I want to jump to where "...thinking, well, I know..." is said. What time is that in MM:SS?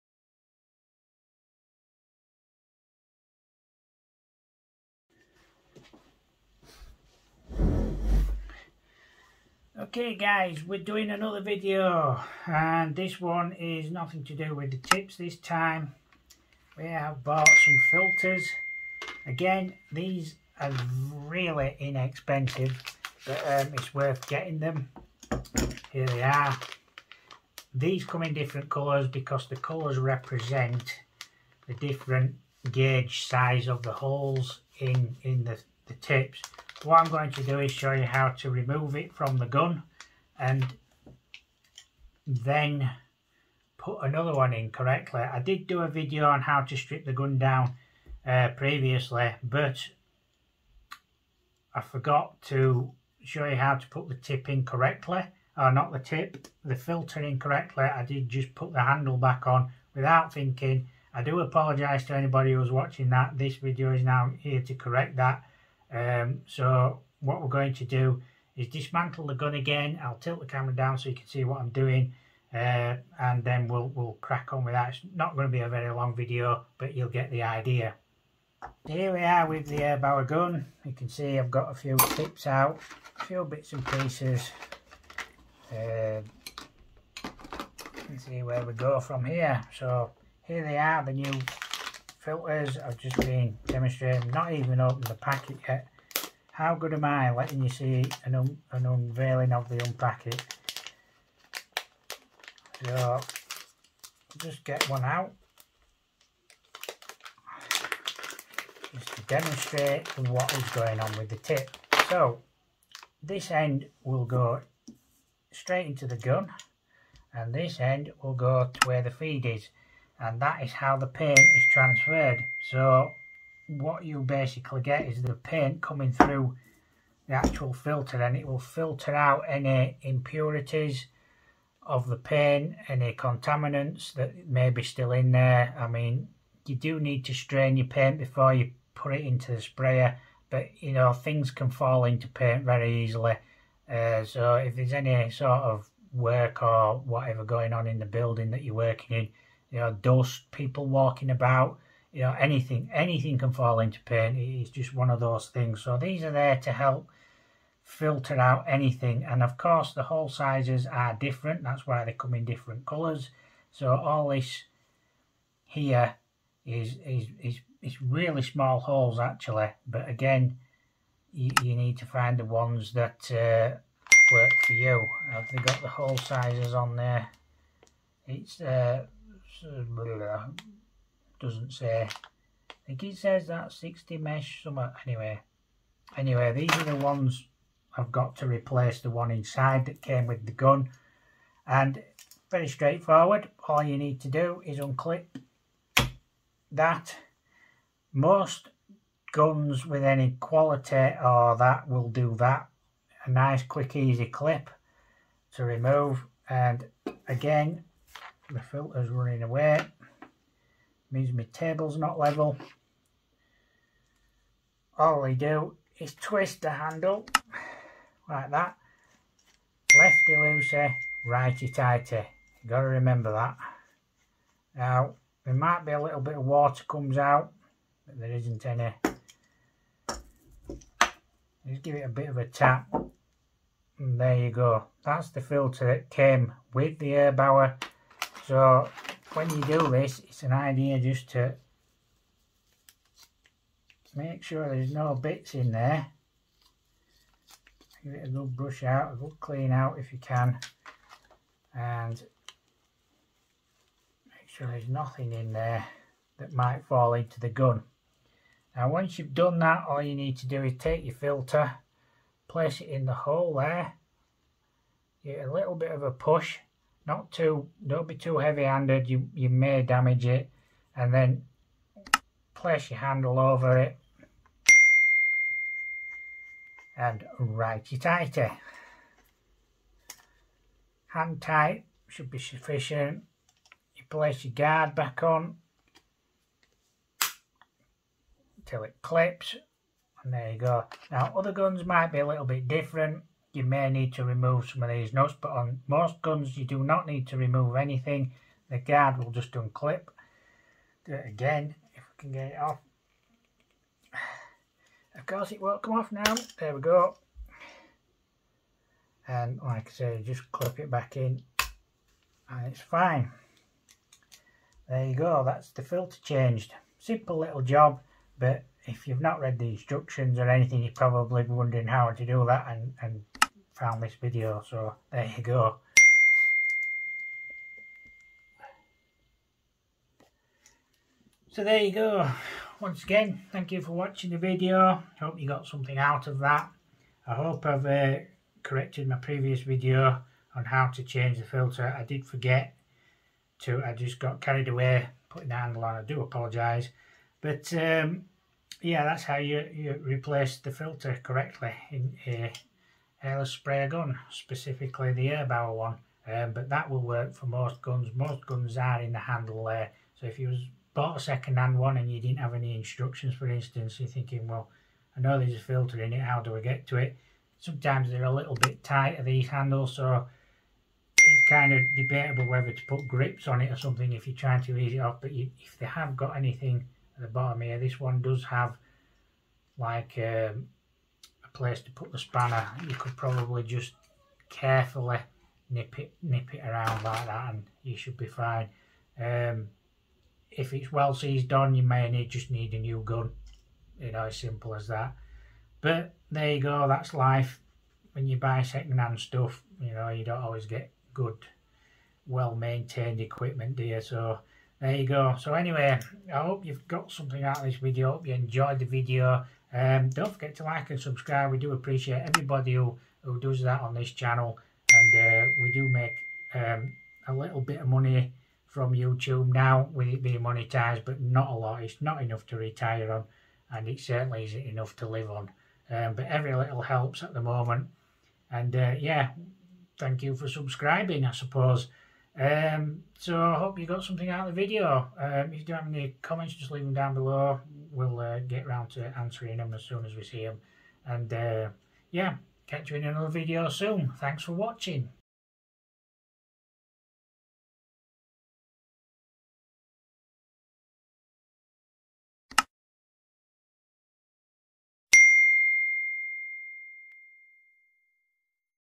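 06:04.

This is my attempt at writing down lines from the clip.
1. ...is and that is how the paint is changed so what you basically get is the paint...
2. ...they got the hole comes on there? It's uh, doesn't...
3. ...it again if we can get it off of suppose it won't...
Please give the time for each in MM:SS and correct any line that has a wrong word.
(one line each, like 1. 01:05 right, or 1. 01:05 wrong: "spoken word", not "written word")
1. 01:59 wrong: "transferred", not "changed"
2. 02:55 wrong: "sizes", not "comes"
3. 05:01 wrong: "course", not "suppose".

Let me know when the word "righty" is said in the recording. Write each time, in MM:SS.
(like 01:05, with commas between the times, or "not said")
03:41, 04:37.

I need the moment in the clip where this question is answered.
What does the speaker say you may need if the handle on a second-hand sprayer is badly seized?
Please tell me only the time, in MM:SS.
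06:32.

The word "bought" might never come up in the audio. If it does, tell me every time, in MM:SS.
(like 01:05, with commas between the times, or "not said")
00:17, 06:00.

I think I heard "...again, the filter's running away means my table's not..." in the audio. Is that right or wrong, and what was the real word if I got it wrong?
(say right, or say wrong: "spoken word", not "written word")
right.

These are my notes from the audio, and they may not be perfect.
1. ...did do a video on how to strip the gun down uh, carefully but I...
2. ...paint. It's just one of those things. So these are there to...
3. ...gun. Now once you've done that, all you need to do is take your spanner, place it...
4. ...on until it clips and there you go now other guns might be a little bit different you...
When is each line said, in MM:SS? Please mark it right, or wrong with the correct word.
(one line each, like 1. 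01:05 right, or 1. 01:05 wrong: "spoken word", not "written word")
1. 00:45 wrong: "previously", not "carefully"
2. 02:34 right
3. 04:17 wrong: "filter", not "spanner"
4. 04:45 right.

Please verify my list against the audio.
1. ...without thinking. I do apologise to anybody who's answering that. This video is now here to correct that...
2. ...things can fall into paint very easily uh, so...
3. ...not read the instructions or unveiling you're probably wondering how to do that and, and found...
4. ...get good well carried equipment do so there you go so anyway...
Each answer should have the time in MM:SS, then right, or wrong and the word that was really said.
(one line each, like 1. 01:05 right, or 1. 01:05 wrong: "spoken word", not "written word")
1. 00:59 wrong: "watching", not "answering"
2. 02:21 right
3. 05:19 wrong: "anything", not "unveiling"
4. 06:40 wrong: "maintained", not "carried".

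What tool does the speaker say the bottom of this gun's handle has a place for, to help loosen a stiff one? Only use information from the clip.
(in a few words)
spanner.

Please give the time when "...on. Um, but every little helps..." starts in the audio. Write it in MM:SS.
07:05.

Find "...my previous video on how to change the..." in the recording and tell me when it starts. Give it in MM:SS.
05:39.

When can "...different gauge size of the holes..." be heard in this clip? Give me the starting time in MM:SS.
00:31.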